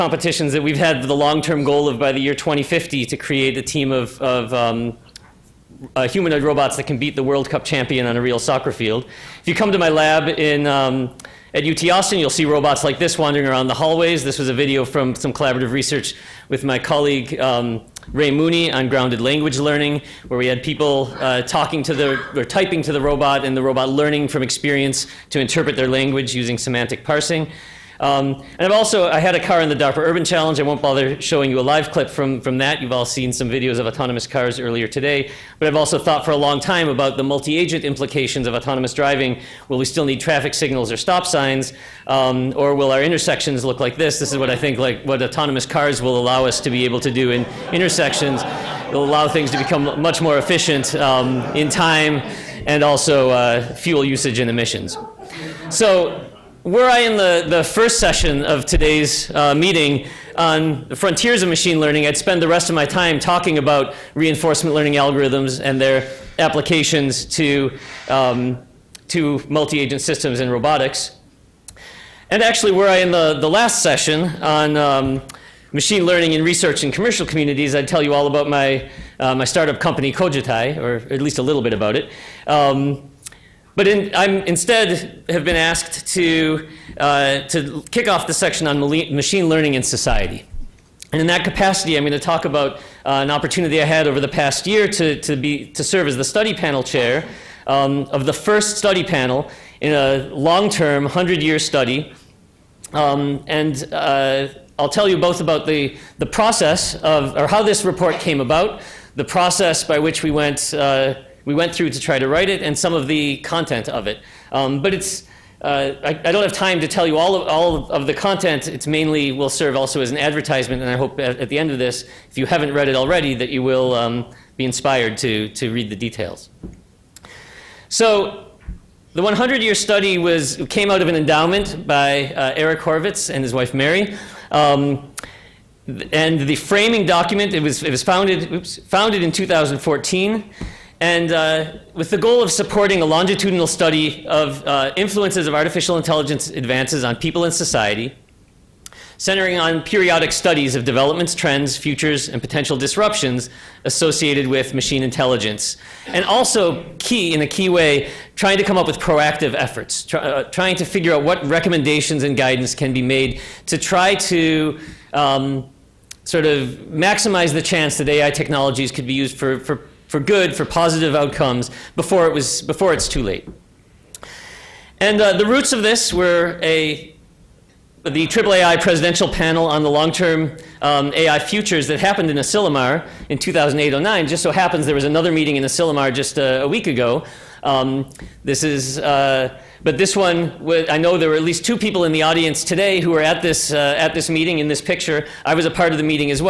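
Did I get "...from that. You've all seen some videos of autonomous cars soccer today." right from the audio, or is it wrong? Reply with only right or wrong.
wrong.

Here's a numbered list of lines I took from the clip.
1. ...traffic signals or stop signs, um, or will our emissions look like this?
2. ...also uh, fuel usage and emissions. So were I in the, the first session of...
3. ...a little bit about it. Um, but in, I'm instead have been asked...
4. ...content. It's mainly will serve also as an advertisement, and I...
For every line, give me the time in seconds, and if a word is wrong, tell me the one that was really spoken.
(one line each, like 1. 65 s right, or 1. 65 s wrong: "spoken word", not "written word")
1. 40 s wrong: "intersections", not "emissions"
2. 52 s right
3. 81 s right
4. 118 s right.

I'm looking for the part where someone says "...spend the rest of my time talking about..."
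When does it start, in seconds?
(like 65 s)
62 s.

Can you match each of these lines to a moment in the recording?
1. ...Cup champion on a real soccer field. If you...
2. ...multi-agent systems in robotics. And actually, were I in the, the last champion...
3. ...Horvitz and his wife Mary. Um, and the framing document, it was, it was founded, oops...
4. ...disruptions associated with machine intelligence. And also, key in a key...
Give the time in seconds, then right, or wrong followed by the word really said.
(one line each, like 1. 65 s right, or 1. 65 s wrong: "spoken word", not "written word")
1. 7 s right
2. 69 s wrong: "session", not "champion"
3. 132 s right
4. 152 s right.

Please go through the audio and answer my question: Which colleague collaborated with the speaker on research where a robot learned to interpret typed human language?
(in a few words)
Ray Mooney.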